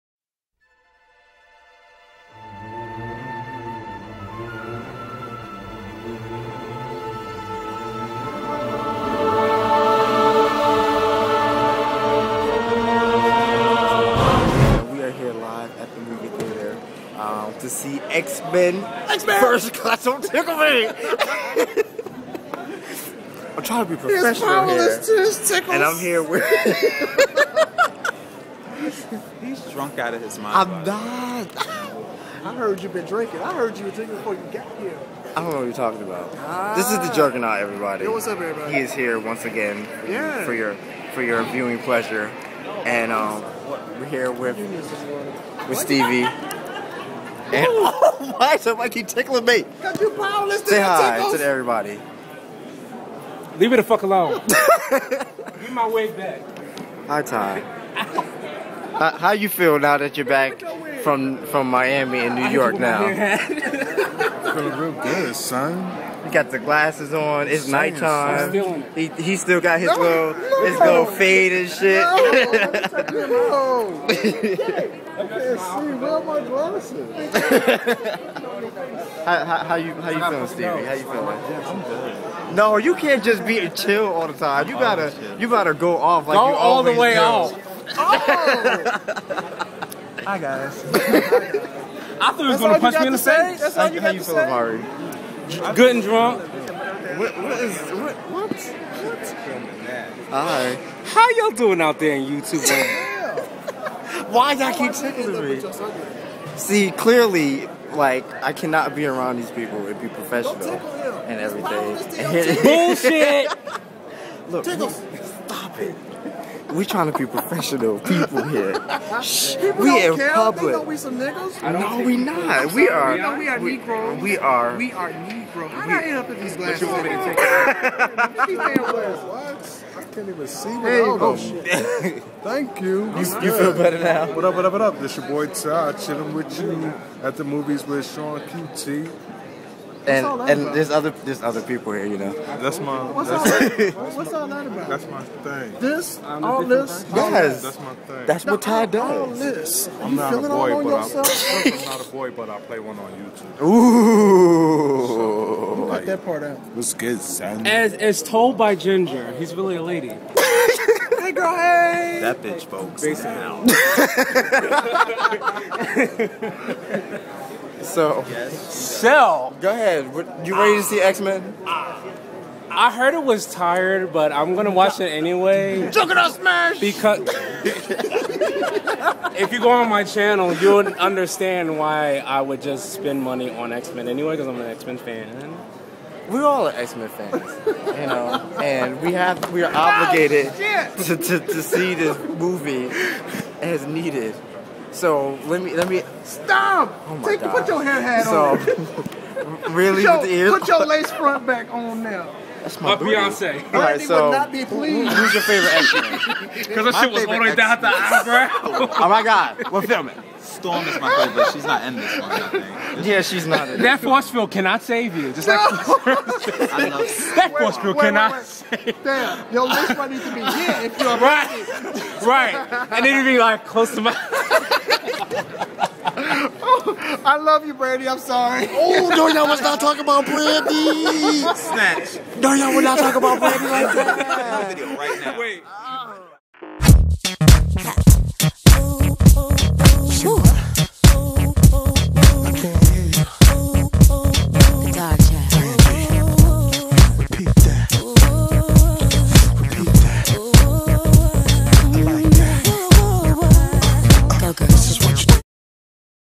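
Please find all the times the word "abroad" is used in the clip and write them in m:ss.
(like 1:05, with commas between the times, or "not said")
not said.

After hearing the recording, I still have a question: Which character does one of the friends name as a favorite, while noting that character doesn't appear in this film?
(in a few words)
Storm.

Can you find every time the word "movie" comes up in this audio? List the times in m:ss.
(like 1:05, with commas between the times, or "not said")
0:16, 2:17, 3:12.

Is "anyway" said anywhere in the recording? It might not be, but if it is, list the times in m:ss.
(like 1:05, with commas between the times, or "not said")
2:55, 3:04.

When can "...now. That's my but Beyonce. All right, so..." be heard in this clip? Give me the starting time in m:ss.
3:22.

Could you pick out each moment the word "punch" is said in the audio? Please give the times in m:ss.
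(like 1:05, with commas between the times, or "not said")
1:32.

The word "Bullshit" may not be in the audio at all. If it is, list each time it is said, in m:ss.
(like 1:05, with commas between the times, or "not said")
1:52.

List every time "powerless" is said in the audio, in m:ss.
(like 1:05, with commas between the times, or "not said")
0:50.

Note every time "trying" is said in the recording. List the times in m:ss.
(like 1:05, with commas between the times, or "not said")
0:23, 1:56.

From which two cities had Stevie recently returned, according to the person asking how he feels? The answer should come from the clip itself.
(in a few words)
Miami and New York.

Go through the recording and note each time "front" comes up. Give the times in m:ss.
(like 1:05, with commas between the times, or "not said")
3:21, 3:39.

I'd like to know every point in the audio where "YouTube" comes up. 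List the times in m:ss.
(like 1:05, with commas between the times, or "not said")
1:42, 2:33.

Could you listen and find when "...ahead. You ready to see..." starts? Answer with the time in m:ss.
2:49.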